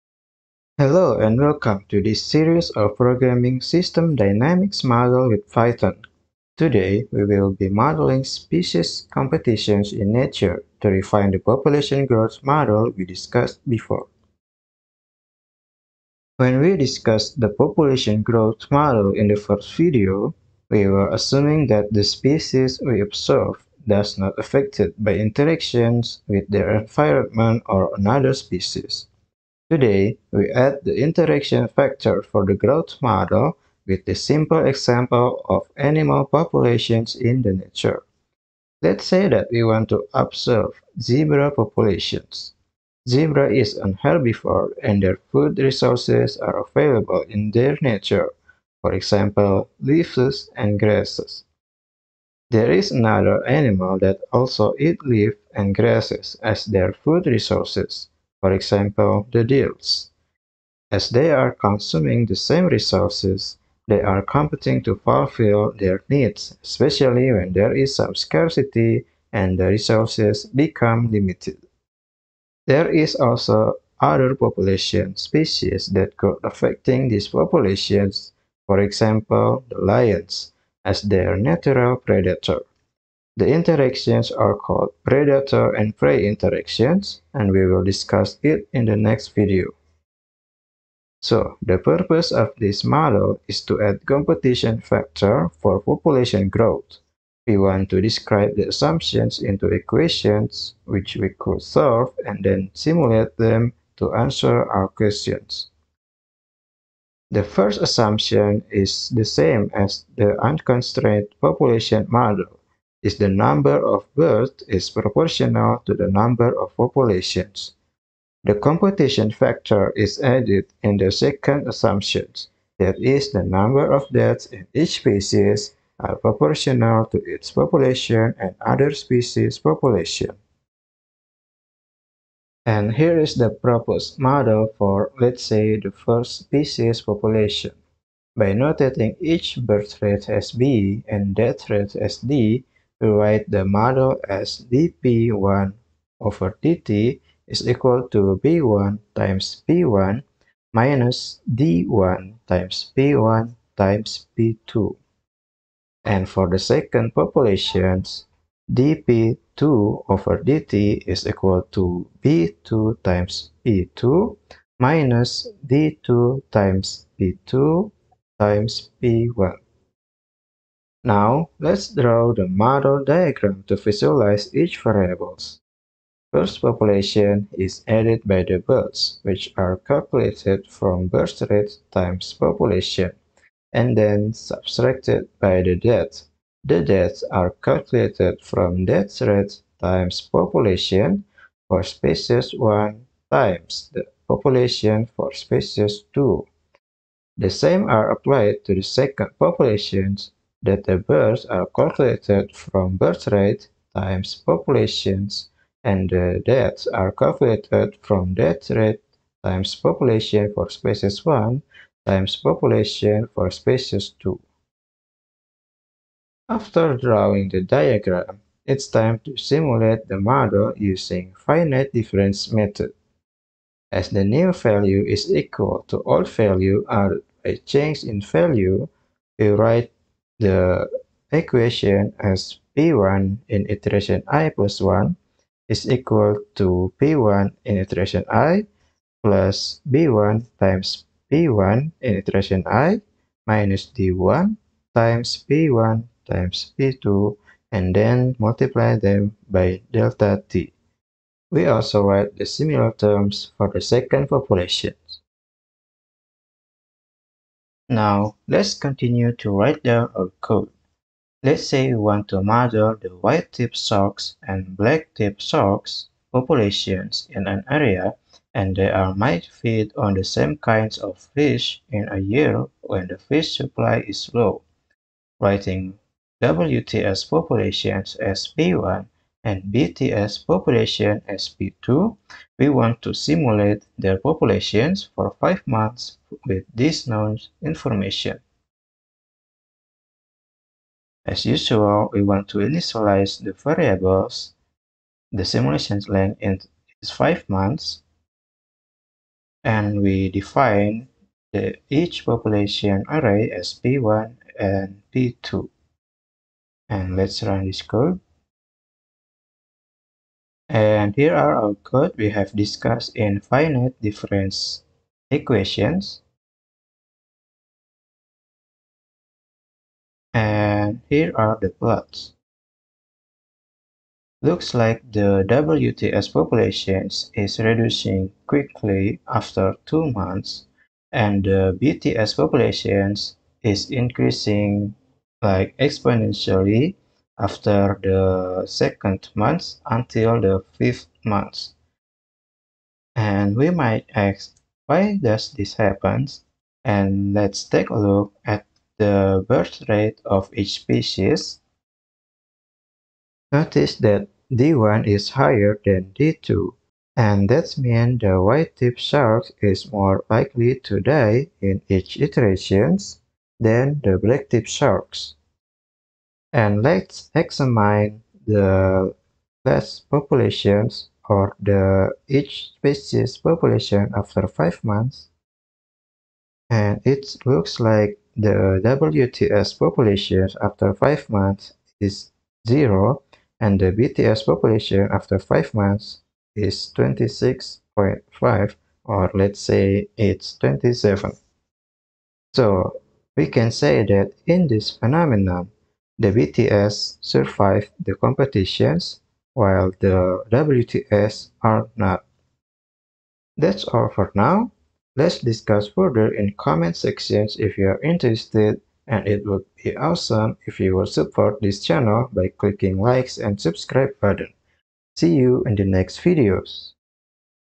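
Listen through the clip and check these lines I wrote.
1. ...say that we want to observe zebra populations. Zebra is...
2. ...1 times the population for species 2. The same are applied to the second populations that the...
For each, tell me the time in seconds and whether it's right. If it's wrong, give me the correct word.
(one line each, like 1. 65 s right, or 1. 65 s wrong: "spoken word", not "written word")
1. 39 s right
2. 192 s right.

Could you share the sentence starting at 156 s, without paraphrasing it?
And for the second population, dp2 over dt is equal to b2 times p2 minus d2 times p2 times p1.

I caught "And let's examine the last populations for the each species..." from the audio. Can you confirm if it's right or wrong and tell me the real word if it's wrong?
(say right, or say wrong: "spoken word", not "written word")
right.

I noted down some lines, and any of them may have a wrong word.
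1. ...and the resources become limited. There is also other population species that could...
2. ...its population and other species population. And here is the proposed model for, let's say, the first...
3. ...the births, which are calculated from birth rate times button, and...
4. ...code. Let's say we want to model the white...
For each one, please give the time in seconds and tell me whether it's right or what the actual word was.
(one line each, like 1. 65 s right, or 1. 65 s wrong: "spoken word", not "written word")
1. 69 s right
2. 127 s right
3. 178 s wrong: "population", not "button"
4. 260 s right.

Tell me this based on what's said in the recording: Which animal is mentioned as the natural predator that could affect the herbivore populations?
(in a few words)
Lions.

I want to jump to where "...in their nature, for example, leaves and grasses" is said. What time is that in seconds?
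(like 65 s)
47 s.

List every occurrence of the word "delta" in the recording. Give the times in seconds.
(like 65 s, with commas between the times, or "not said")
249 s.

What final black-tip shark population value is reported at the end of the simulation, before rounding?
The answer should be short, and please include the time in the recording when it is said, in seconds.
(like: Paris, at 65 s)
26.5, at 386 s.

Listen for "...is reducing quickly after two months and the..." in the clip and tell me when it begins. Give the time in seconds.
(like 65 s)
327 s.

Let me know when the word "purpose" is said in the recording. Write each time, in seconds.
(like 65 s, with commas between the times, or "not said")
91 s.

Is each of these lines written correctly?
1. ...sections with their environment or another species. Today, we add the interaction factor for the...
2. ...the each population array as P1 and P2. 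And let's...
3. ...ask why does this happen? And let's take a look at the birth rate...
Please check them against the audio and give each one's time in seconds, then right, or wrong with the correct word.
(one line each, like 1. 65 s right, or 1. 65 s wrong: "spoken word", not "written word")
1. 25 s wrong: "interactions", not "sections"
2. 301 s right
3. 344 s right.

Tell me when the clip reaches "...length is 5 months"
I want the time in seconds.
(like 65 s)
296 s.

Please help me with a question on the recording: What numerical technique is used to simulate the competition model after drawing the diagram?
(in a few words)
Finite difference method.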